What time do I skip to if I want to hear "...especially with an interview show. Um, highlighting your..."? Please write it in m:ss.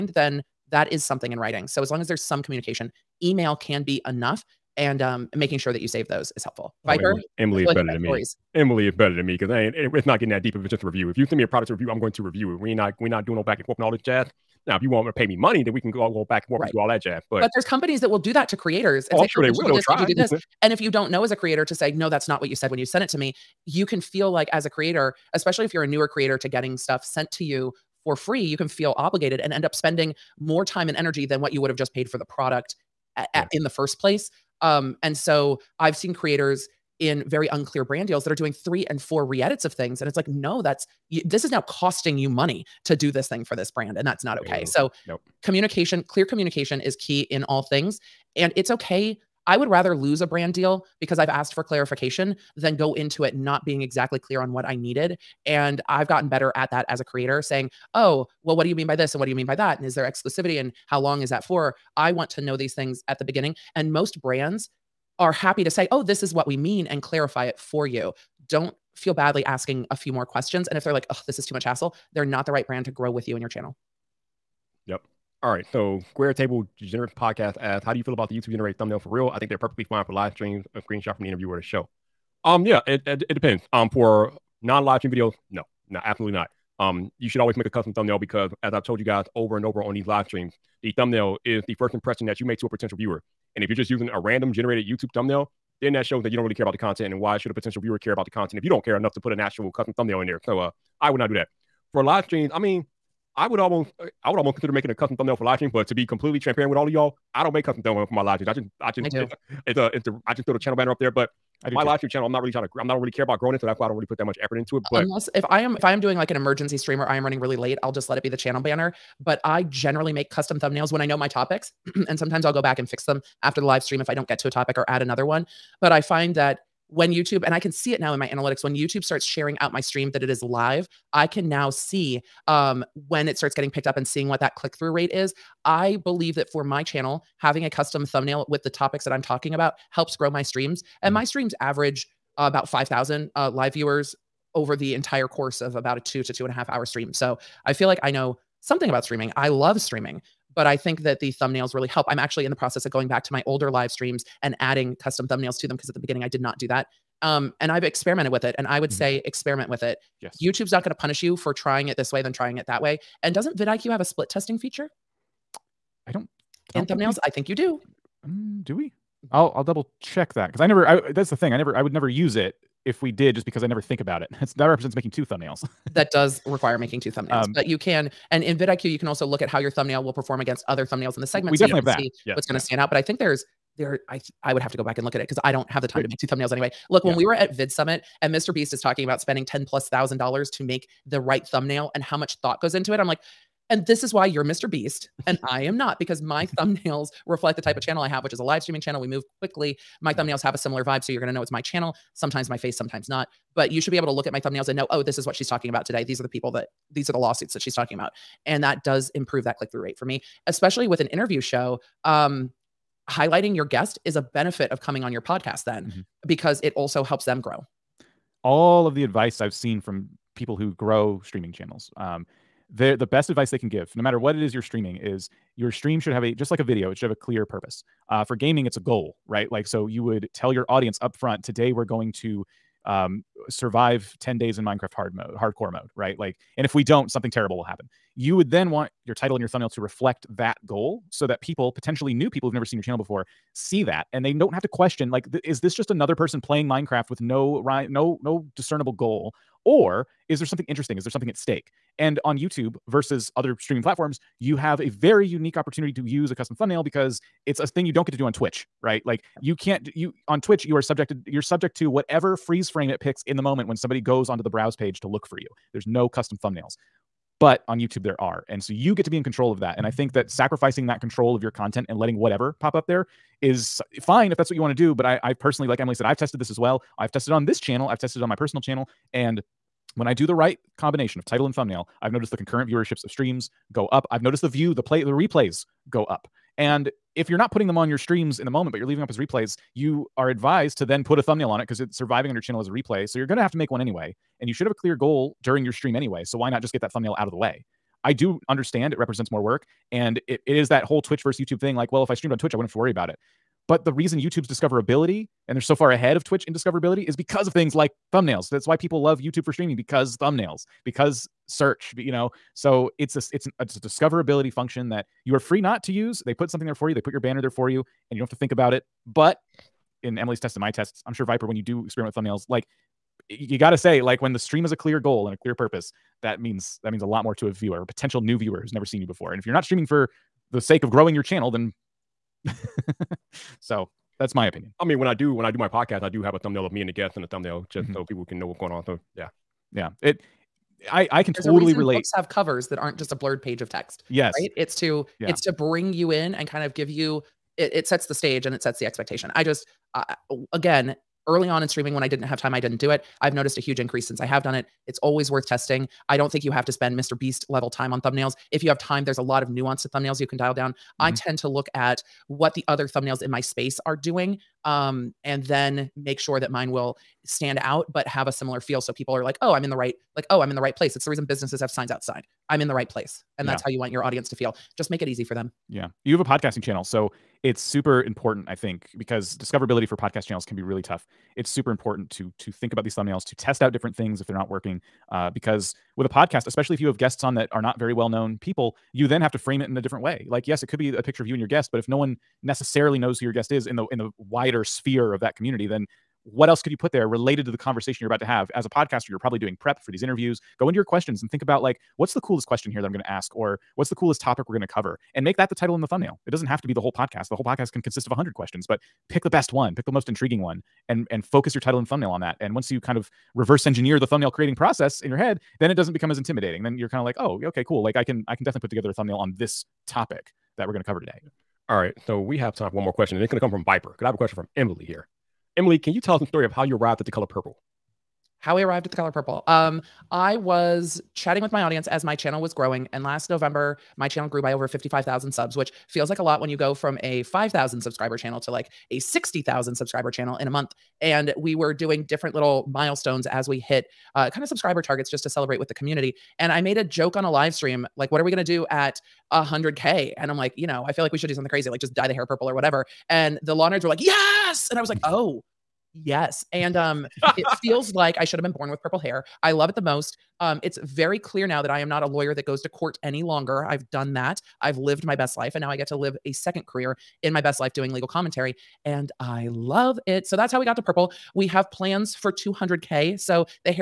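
3:30.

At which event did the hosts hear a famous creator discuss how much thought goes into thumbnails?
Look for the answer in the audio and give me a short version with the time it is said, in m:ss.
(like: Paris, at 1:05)
Vid Summit, at 3:07.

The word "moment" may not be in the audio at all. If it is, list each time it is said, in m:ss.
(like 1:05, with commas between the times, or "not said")
4:23, 4:48.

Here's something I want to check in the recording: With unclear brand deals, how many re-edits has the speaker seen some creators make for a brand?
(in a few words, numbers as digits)
3 and 4.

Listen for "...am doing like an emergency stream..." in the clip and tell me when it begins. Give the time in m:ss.
1:55.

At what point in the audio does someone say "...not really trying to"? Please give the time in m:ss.
1:52.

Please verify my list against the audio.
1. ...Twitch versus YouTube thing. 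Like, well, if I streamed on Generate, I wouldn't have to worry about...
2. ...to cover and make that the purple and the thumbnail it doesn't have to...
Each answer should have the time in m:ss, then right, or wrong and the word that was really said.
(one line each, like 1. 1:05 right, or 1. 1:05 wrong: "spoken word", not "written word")
1. 5:00 wrong: "Twitch", not "Generate"
2. 6:44 wrong: "title", not "purple".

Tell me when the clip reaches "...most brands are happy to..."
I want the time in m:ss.
1:03.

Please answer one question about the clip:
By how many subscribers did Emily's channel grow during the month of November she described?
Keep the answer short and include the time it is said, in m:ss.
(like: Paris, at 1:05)
55,000, at 7:14.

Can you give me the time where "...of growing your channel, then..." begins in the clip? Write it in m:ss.
5:30.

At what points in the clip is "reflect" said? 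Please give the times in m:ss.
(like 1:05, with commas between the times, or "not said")
3:17, 3:59.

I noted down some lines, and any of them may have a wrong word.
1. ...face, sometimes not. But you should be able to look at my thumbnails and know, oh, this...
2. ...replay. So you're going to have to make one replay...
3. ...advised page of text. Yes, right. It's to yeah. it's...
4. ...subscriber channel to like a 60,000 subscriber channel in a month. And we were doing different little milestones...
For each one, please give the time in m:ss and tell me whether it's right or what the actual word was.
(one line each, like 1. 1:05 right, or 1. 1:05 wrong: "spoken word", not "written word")
1. 3:22 right
2. 4:52 wrong: "anyway", not "replay"
3. 5:43 wrong: "blurred", not "advised"
4. 7:17 right.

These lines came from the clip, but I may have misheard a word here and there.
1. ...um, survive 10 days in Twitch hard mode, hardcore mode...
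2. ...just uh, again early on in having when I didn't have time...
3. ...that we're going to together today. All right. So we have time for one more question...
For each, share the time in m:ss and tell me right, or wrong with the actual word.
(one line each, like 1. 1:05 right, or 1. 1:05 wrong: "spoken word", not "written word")
1. 3:52 wrong: "Minecraft", not "Twitch"
2. 5:49 wrong: "streaming", not "having"
3. 7:00 wrong: "cover", not "together".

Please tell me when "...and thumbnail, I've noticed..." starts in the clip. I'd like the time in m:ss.
4:41.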